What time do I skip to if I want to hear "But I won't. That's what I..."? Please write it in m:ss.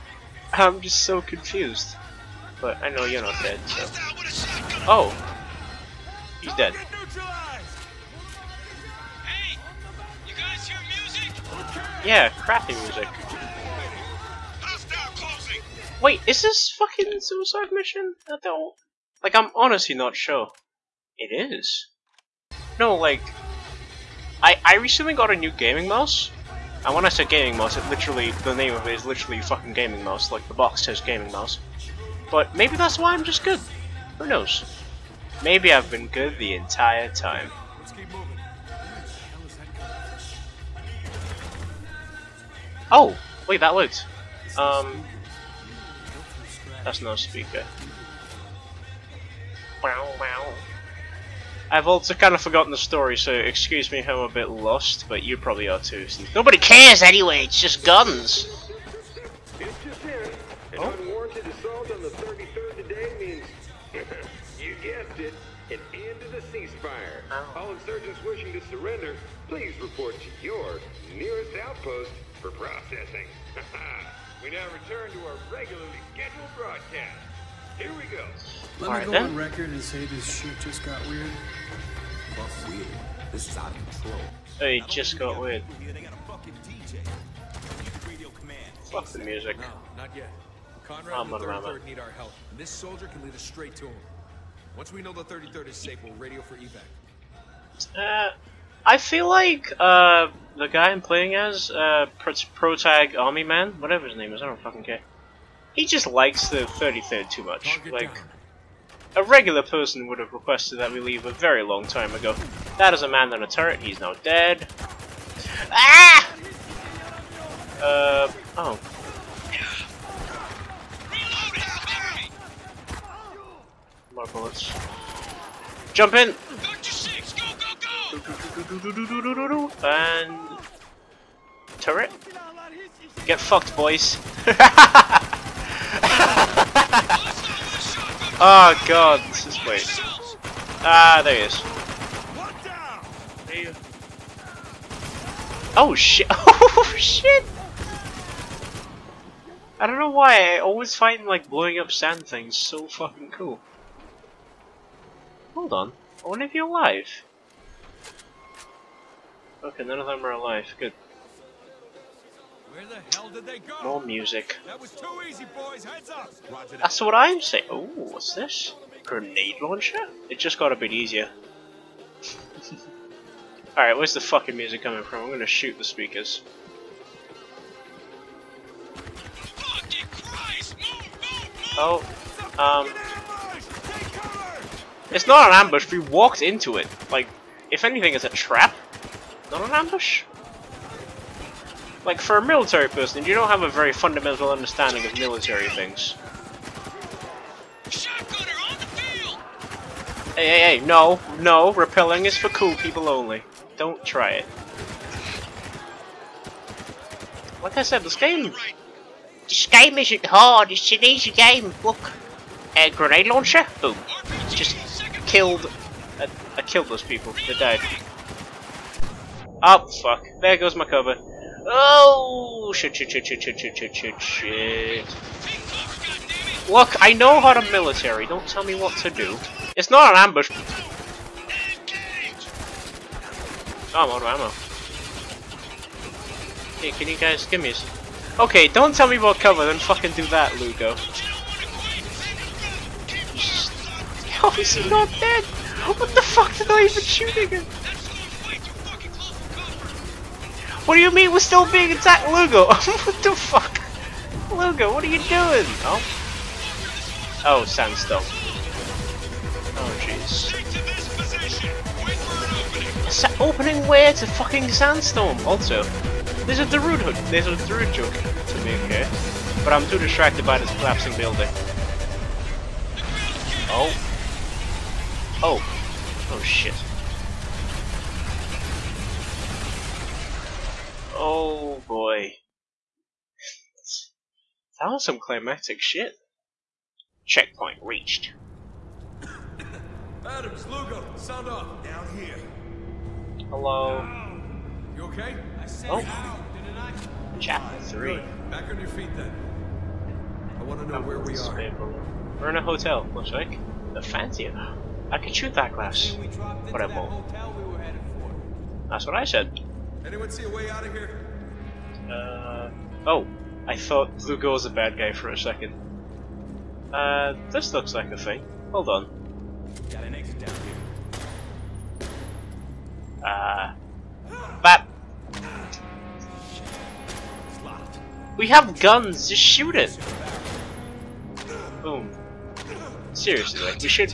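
5:06.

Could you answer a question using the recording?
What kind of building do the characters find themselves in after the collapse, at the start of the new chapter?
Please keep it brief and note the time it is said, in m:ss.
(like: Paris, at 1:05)
A hotel, at 5:02.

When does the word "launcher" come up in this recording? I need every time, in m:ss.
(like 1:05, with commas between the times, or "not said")
2:49, 3:33.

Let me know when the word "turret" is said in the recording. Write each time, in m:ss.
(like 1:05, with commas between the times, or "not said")
1:53, 2:11.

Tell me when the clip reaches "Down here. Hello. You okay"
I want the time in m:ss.
4:51.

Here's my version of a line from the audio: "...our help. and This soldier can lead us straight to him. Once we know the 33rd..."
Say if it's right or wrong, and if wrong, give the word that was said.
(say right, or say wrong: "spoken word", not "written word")
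right.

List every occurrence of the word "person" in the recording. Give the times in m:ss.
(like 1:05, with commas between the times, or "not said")
1:49, 3:12.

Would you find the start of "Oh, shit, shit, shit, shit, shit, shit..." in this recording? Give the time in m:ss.
3:41.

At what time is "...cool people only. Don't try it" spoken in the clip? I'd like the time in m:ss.
3:22.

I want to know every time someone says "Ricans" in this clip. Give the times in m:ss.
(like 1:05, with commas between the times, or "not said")
not said.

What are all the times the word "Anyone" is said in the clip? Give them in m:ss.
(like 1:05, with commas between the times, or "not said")
5:10.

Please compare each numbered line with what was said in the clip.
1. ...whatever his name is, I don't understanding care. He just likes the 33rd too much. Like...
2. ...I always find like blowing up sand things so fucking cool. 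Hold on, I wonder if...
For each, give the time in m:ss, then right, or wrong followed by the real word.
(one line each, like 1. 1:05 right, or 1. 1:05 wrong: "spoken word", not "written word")
1. 1:43 wrong: "fucking", not "understanding"
2. 2:30 right.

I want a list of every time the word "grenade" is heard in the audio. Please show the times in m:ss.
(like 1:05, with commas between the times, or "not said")
2:49, 3:32.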